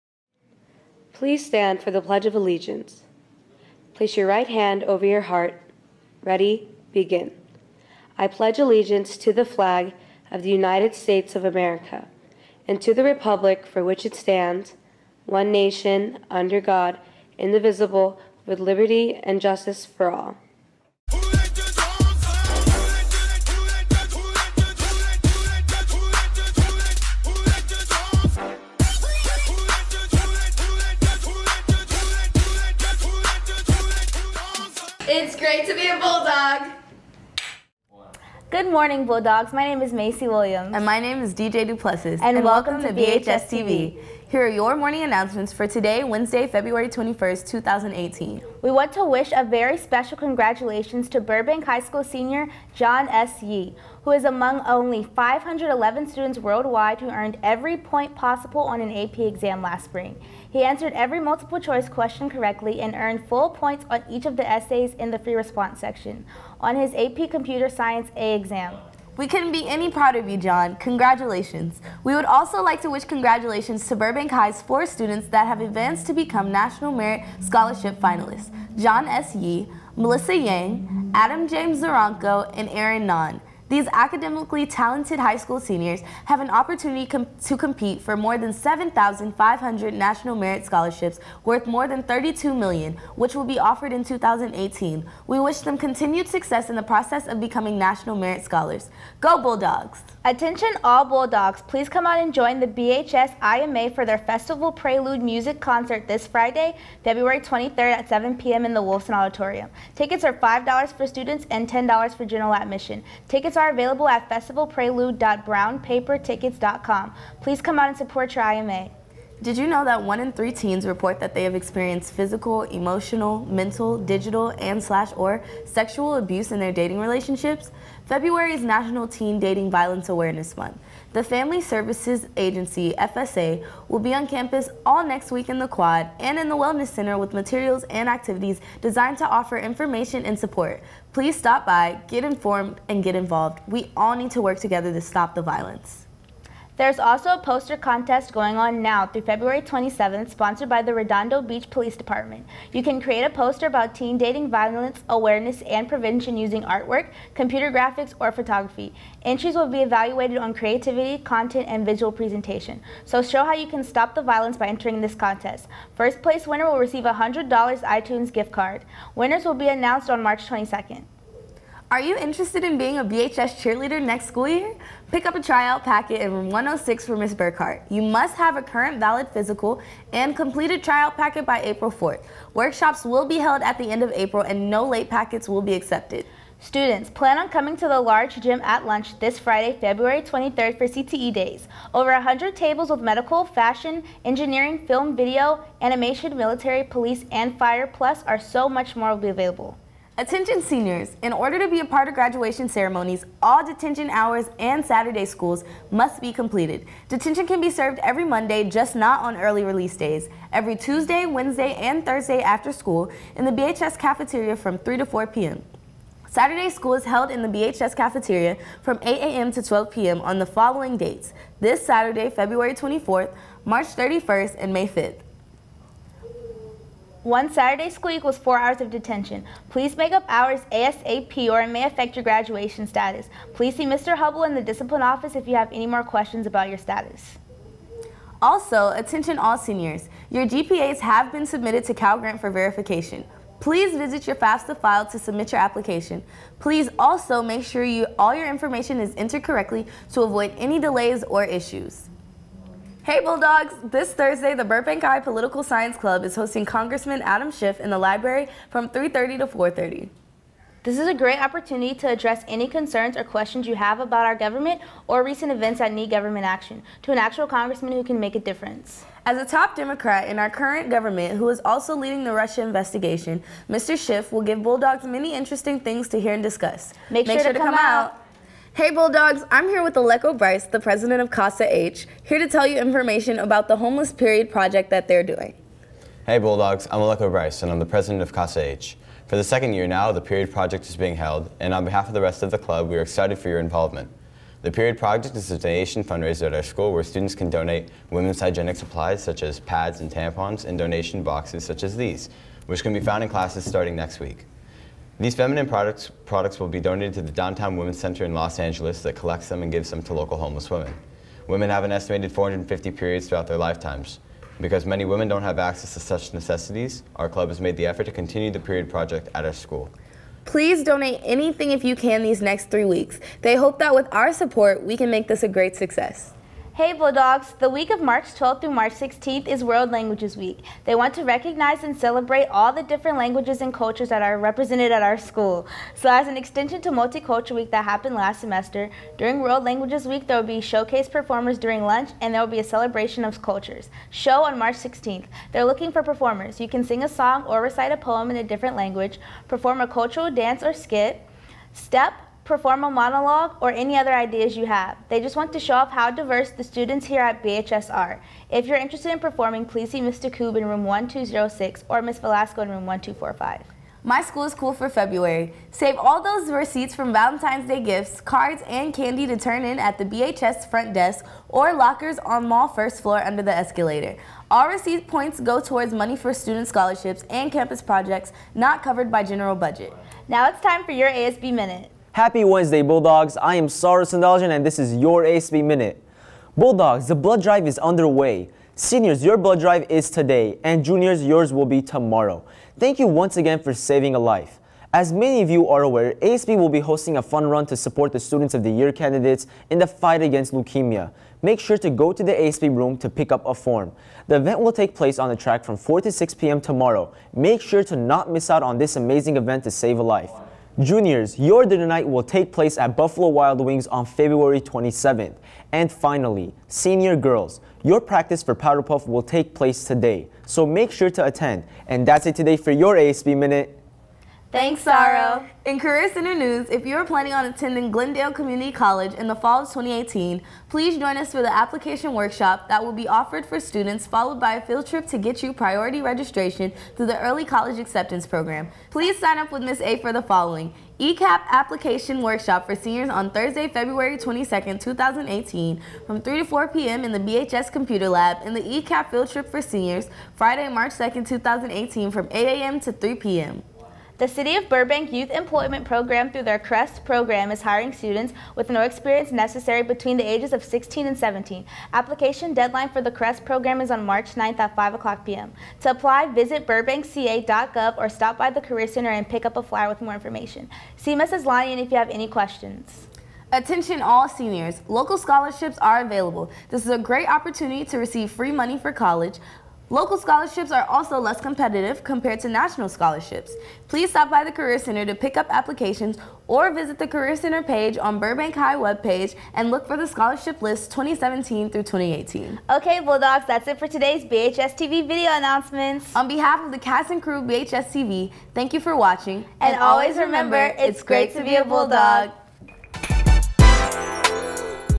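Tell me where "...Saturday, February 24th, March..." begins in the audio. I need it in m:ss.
3:41.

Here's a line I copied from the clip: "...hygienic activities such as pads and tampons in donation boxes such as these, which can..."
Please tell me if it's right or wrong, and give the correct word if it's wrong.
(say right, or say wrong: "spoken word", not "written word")
wrong: "supplies", not "activities".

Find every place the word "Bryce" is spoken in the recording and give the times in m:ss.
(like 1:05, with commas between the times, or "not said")
4:40, 4:47.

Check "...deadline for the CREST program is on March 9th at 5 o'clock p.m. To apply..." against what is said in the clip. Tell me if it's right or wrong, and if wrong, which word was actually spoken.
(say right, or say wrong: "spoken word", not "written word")
right.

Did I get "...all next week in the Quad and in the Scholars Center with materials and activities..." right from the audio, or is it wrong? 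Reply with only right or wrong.
wrong.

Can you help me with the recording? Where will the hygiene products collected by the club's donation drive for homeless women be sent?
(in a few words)
Downtown Women's Center.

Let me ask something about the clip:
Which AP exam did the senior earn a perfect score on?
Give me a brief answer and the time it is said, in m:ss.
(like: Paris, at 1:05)
Computer Science A, at 1:07.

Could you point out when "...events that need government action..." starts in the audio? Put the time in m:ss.
4:25.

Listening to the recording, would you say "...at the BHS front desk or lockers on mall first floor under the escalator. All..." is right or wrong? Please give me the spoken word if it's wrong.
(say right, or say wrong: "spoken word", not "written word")
right.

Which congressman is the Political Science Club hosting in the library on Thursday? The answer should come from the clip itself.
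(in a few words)
Adam Schiff.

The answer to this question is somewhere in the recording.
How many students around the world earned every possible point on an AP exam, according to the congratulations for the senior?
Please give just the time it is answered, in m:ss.
0:55.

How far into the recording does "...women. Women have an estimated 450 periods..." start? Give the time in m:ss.
5:10.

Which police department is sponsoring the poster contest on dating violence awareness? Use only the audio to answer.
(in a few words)
Redondo Beach.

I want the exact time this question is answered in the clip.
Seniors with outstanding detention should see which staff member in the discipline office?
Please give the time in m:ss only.
3:53.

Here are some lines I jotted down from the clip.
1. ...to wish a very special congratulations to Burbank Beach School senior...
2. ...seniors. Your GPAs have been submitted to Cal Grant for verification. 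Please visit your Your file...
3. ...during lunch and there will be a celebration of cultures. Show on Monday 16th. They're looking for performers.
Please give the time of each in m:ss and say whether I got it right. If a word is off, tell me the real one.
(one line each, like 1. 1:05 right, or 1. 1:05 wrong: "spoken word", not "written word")
1. 0:48 wrong: "High", not "Beach"
2. 3:59 wrong: "FAFSA", not "Your"
3. 5:41 wrong: "March", not "Monday".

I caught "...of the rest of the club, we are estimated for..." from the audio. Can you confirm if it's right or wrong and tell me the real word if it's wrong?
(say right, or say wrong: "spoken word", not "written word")
wrong: "excited", not "estimated".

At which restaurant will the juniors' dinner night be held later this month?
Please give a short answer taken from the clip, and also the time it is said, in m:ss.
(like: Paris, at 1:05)
Buffalo Wild Wings, at 6:52.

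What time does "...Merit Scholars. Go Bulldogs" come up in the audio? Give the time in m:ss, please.
1:38.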